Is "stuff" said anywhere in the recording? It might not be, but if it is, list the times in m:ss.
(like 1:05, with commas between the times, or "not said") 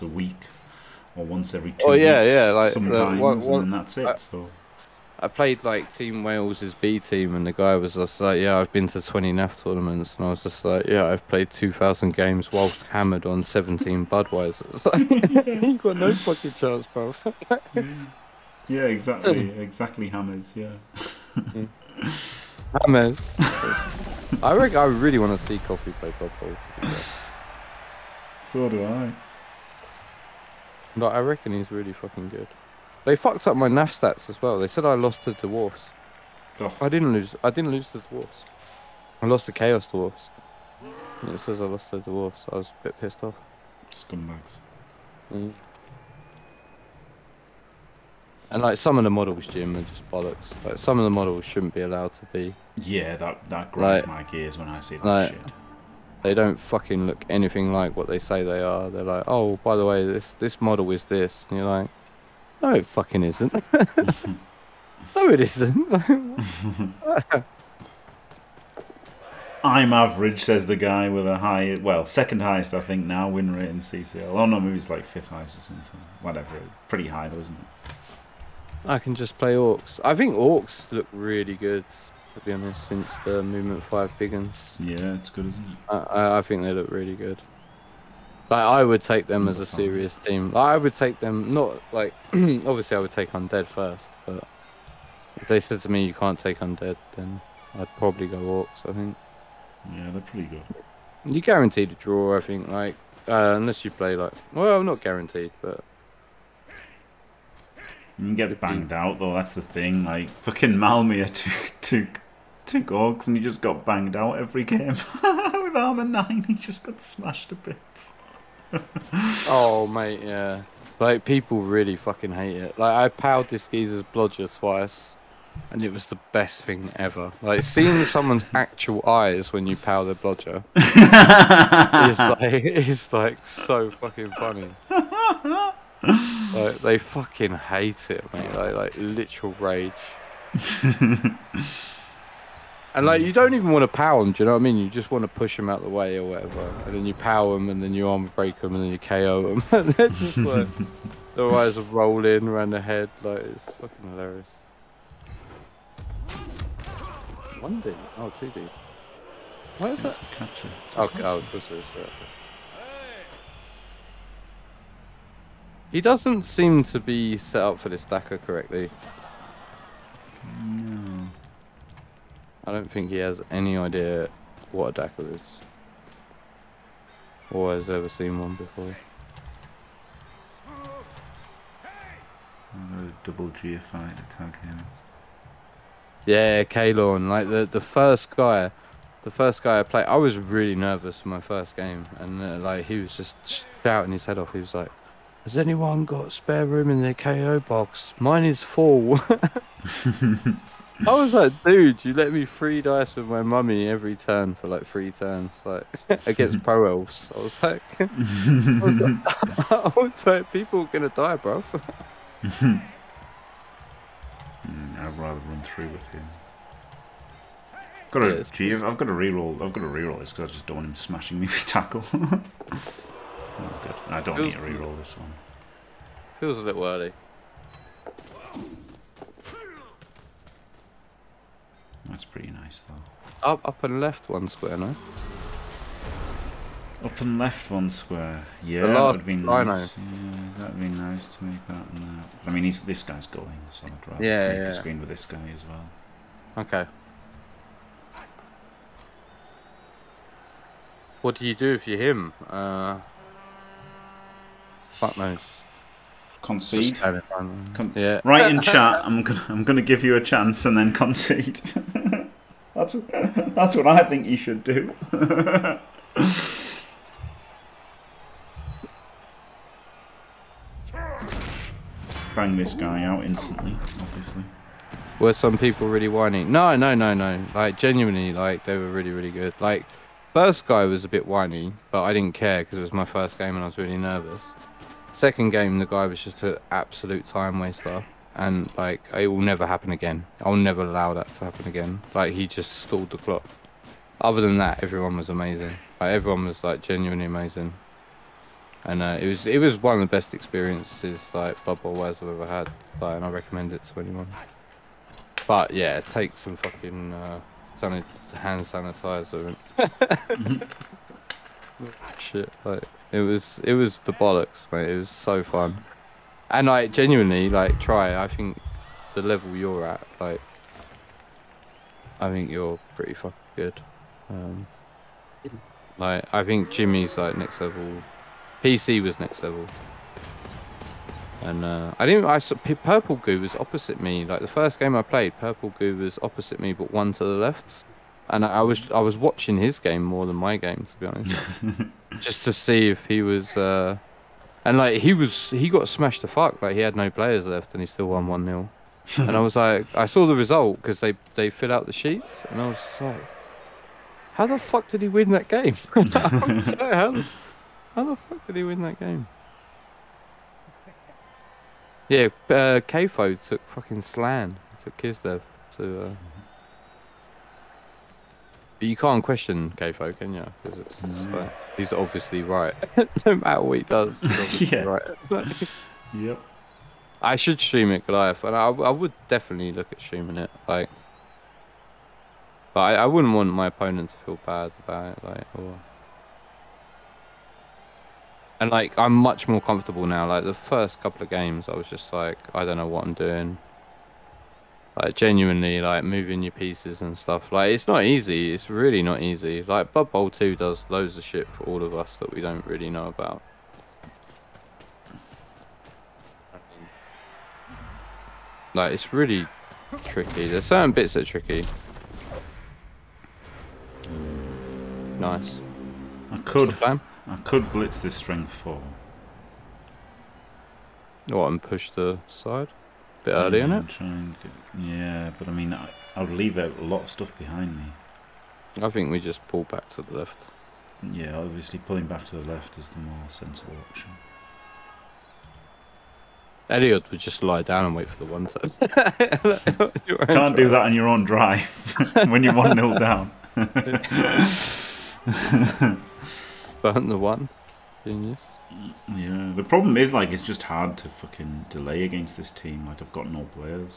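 6:37, 7:07.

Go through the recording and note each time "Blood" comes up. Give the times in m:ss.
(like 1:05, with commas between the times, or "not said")
0:26, 6:39.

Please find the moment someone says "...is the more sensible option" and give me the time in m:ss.
7:12.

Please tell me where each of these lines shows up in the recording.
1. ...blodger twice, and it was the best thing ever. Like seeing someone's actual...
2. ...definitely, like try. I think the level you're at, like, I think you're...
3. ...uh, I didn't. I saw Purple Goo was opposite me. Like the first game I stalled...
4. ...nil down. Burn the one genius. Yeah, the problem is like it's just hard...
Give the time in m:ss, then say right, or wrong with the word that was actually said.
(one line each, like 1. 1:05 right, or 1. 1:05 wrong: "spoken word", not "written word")
1. 2:04 right
2. 5:16 wrong: "genuinely", not "definitely"
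3. 5:31 wrong: "played", not "stalled"
4. 7:22 right.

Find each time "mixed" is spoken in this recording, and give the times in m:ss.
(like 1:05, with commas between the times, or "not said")
not said.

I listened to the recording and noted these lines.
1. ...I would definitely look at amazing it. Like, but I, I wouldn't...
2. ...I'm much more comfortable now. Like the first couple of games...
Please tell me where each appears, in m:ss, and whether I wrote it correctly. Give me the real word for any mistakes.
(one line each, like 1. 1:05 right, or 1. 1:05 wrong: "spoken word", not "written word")
1. 6:18 wrong: "streaming", not "amazing"
2. 6:28 right.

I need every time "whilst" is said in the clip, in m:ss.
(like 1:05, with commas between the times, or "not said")
0:12.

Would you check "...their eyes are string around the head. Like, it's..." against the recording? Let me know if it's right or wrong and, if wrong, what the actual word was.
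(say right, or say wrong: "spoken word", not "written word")
wrong: "rolling", not "string".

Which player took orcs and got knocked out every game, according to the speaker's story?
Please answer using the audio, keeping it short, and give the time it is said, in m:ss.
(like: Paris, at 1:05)
Malmia, at 1:50.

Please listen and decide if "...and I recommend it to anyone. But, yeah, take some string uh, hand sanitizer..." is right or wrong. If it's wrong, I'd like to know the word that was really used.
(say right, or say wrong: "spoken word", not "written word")
wrong: "fucking", not "string".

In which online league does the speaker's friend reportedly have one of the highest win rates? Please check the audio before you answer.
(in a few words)
CCL.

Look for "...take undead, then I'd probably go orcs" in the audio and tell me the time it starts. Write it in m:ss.
1:36.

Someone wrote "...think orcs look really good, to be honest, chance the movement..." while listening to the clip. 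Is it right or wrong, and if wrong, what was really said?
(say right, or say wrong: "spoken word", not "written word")
wrong: "since", not "chance".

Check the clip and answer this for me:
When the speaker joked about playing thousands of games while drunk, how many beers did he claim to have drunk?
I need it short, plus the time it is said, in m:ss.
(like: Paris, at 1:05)
17, at 0:13.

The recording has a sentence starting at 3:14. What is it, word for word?
He was like, "Has anyone got spare room in their KO box?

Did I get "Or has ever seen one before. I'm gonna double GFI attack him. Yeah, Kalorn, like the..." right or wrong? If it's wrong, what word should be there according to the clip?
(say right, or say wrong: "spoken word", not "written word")
right.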